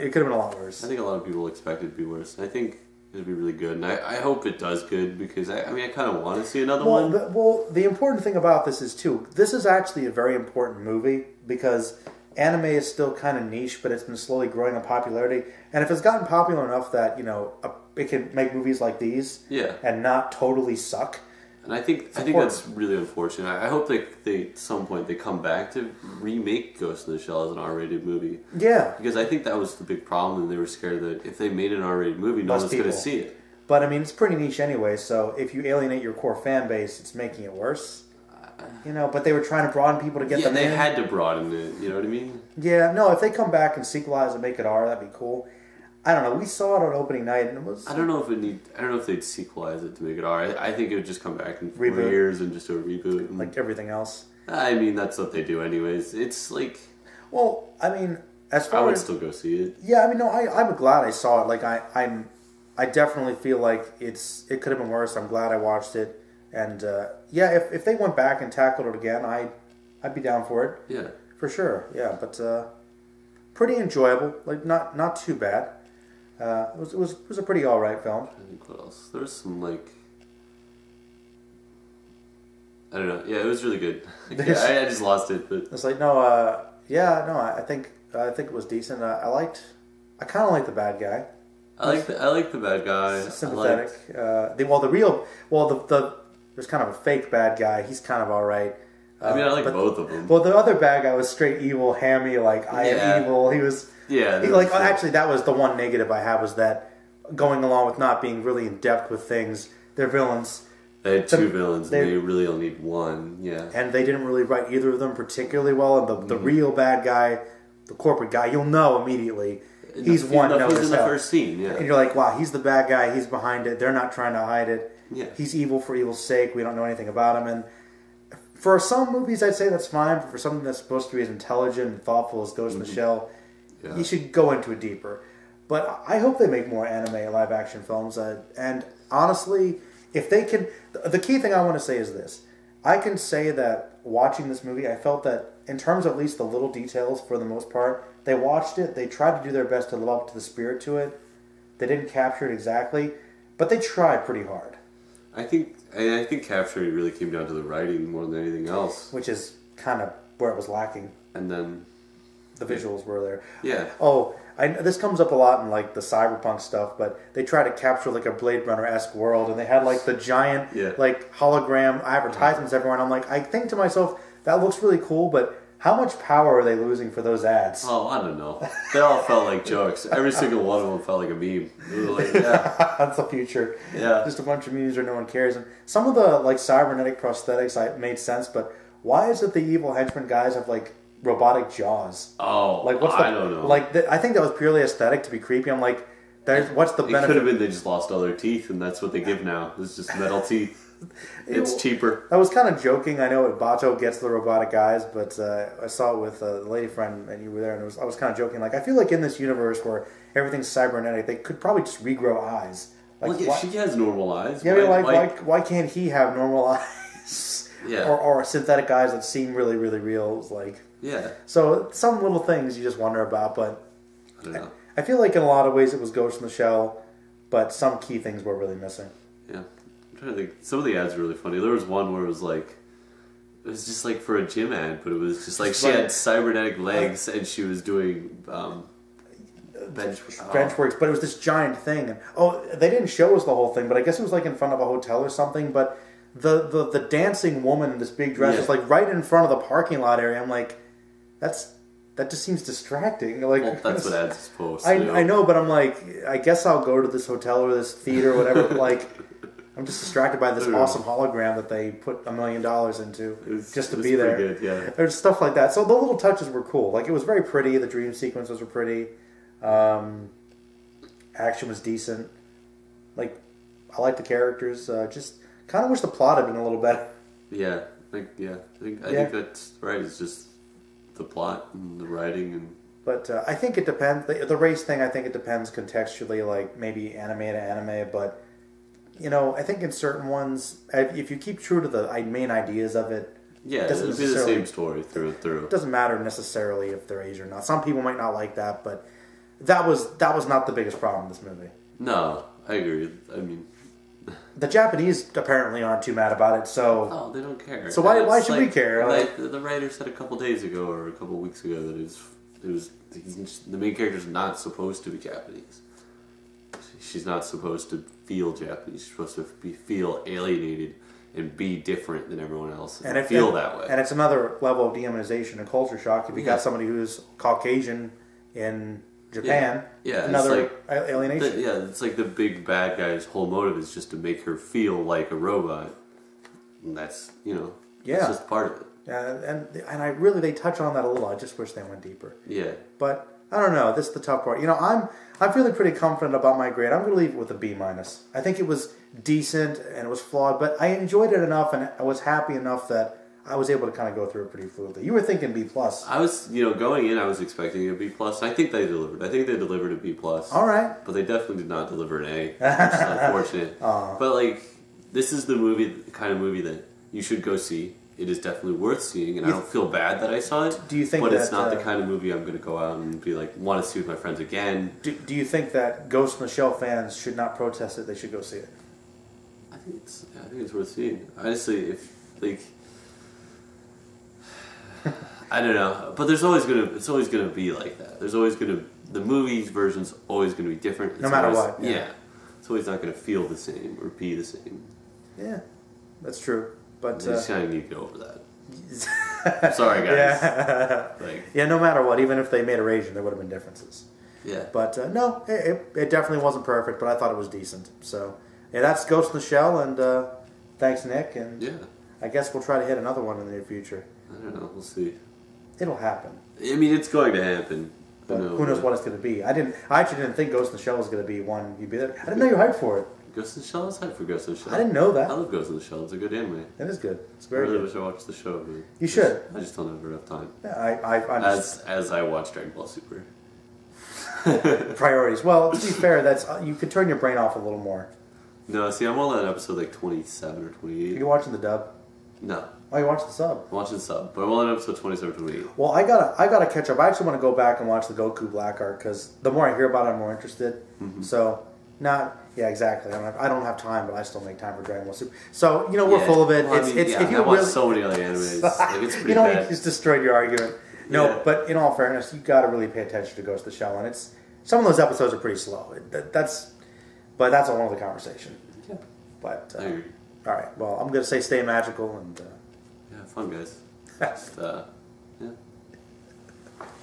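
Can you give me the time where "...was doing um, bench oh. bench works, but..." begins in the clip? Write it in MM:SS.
03:57.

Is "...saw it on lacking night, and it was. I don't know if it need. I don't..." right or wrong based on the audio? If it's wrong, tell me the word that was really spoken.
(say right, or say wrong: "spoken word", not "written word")
wrong: "opening", not "lacking".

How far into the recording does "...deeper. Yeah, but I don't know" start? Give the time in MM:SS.
05:42.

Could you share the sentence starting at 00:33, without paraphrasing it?
But I mean, it's pretty niche anyway.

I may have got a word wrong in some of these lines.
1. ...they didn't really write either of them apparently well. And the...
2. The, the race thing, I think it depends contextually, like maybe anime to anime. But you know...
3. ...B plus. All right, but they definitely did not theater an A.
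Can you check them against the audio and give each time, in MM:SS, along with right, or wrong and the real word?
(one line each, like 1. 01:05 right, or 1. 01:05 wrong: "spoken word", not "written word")
1. 01:53 wrong: "particularly", not "apparently"
2. 04:44 right
3. 05:59 wrong: "deliver", not "theater".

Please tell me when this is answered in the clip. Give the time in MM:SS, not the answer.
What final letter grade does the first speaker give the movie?
05:47.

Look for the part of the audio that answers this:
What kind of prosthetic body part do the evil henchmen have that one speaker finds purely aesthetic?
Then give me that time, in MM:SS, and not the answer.
03:11.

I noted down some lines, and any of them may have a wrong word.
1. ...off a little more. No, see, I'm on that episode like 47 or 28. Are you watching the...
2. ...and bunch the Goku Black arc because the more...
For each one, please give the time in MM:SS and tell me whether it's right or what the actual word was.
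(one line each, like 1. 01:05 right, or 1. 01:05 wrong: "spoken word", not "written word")
1. 07:17 wrong: "27", not "47"
2. 07:27 wrong: "watch", not "bunch".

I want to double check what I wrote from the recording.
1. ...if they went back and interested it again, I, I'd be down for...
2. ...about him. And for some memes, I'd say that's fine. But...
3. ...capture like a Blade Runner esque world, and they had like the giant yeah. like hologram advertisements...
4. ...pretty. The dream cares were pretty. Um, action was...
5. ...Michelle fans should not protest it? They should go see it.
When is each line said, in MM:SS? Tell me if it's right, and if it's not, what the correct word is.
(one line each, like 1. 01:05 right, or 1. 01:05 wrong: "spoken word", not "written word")
1. 01:07 wrong: "tackled", not "interested"
2. 02:07 wrong: "movies", not "memes"
3. 02:47 right
4. 04:27 wrong: "sequences", not "cares"
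5. 06:16 right.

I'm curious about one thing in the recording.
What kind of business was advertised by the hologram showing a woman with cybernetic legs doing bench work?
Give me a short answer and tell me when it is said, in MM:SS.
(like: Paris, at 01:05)
gym, at 03:54.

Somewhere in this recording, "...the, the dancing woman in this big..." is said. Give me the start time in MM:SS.
04:06.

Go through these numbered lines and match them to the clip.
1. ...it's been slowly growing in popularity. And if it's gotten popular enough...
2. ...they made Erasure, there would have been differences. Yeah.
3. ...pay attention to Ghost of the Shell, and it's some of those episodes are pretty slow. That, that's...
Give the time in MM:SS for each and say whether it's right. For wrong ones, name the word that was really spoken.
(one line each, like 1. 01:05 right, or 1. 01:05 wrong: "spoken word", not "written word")
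1. 00:13 right
2. 06:42 right
3. 07:42 right.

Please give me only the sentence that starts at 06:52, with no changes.
I guess we'll try to hit another one in the near future.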